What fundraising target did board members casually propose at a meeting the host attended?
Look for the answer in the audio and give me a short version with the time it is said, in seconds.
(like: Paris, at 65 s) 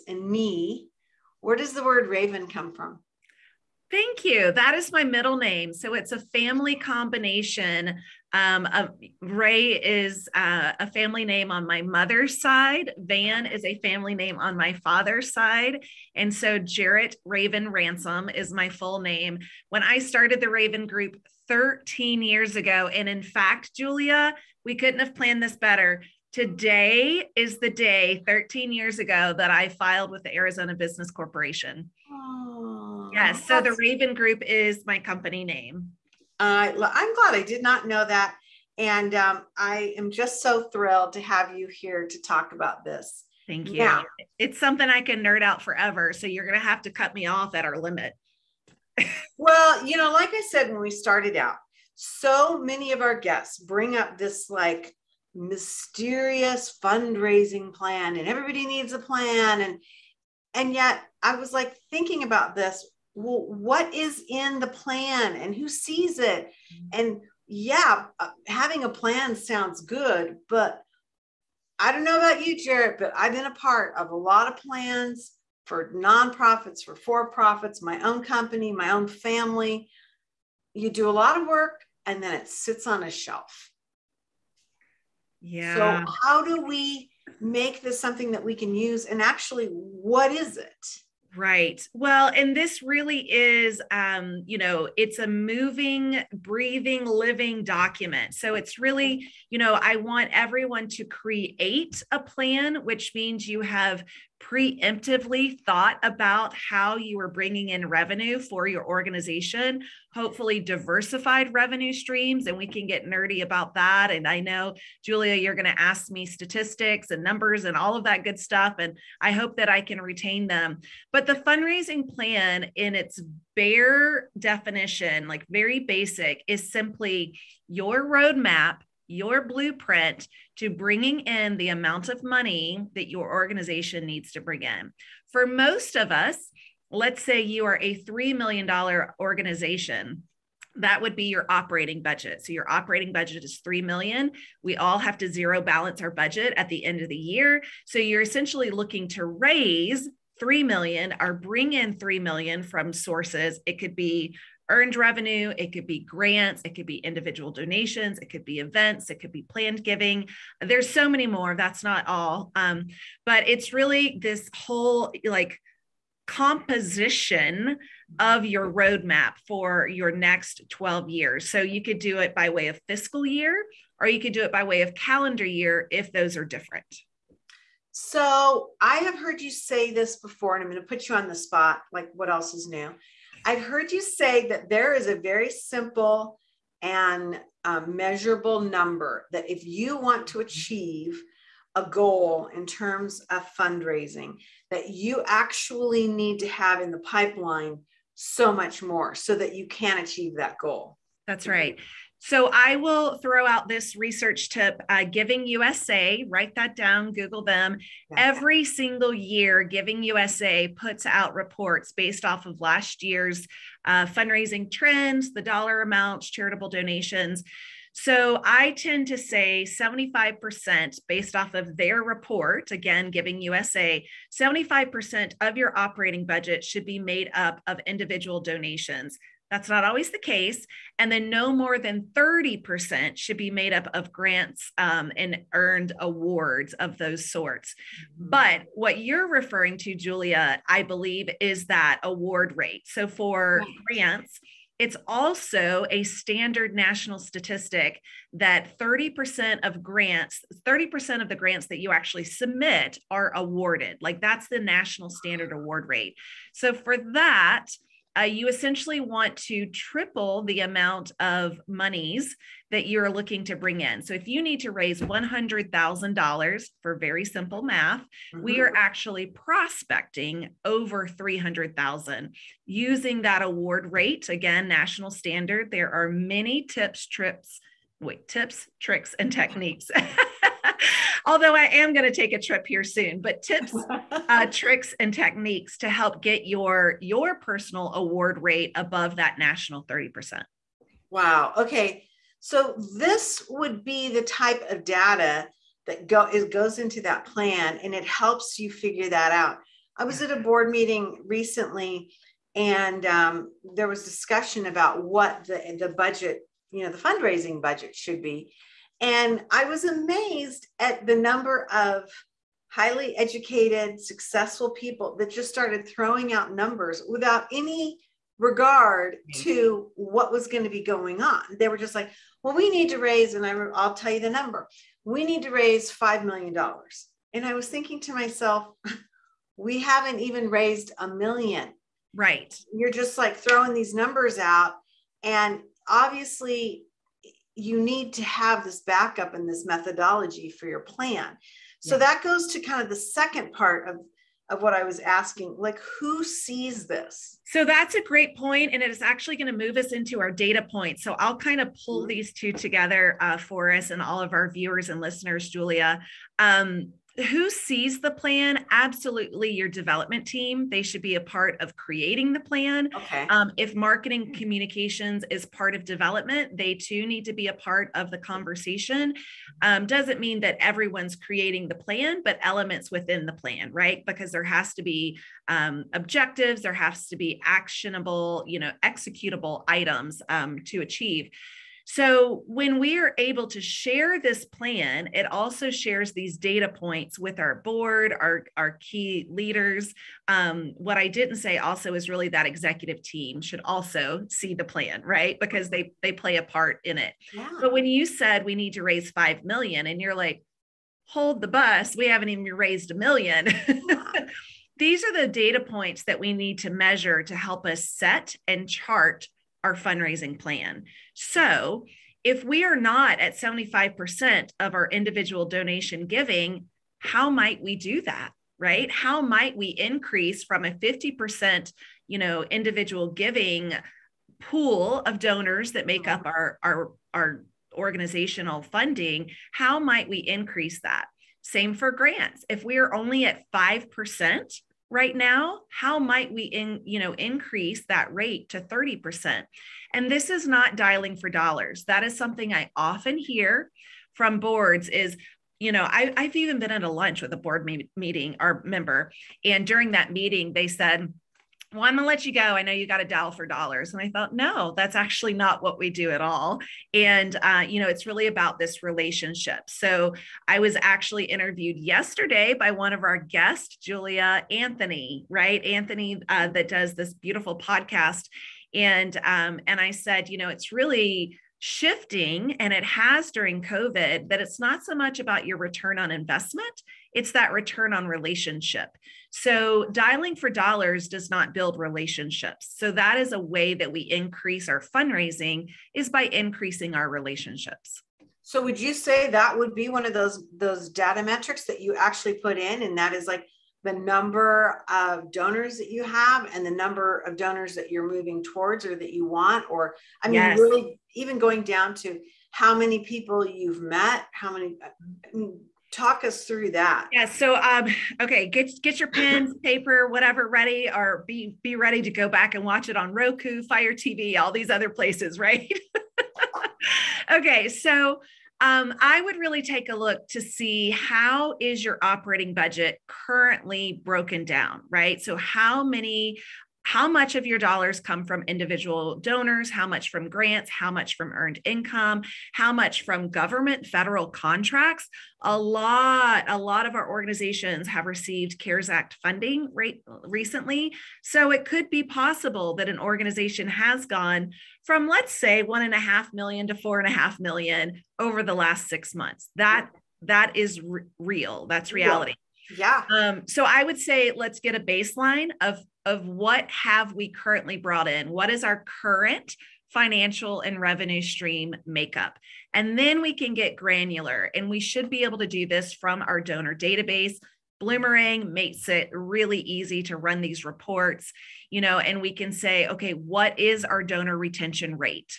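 $5 million, at 325 s.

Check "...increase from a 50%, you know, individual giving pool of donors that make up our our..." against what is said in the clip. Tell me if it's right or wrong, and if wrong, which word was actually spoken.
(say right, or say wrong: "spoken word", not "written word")
right.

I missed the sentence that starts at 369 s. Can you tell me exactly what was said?
Um, doesn't mean that everyone's creating the plan, but elements within the plan, right?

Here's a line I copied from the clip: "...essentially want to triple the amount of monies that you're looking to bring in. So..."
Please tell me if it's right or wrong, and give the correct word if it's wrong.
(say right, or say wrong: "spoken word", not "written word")
right.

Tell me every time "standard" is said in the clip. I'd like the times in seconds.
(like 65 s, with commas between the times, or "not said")
246 s, 255 s, 275 s.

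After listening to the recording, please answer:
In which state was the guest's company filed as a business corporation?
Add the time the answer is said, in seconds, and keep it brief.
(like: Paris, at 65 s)
Arizona, at 30 s.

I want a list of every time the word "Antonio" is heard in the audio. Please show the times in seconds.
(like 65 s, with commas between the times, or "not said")
not said.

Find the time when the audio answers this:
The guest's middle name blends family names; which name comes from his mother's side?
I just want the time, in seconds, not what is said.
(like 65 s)
9 s.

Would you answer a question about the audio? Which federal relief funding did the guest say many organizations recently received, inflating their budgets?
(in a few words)
CARES Act.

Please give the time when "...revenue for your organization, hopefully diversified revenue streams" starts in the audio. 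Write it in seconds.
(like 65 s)
107 s.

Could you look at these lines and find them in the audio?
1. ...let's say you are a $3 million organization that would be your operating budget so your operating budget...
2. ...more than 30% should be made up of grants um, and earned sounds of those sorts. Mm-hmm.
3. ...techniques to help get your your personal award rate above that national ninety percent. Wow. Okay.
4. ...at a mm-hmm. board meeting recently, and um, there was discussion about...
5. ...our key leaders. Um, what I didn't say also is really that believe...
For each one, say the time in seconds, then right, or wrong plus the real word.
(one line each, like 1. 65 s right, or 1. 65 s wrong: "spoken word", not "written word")
1. 136 s right
2. 231 s wrong: "awards", not "sounds"
3. 285 s wrong: "thirty", not "ninety"
4. 300 s right
5. 388 s wrong: "executive", not "believe".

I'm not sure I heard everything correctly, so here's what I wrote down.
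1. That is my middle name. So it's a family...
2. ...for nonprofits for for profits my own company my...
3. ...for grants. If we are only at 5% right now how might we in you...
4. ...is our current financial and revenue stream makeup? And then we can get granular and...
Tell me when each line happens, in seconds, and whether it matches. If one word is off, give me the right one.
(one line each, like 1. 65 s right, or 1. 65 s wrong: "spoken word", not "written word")
1. 4 s right
2. 75 s right
3. 431 s right
4. 558 s right.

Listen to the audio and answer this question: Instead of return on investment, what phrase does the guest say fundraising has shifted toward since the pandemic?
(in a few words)
return on relationship.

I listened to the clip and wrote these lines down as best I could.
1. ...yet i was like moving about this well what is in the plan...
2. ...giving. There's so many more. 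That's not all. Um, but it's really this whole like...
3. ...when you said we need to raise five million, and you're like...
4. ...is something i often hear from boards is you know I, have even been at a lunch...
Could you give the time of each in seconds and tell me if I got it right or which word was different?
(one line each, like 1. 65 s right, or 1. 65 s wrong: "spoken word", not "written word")
1. 60 s wrong: "thinking", not "moving"
2. 159 s right
3. 397 s right
4. 442 s right.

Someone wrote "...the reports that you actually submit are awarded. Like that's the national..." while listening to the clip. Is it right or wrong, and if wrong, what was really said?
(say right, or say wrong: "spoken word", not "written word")
wrong: "grants", not "reports".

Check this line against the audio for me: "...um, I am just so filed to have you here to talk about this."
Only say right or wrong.
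wrong.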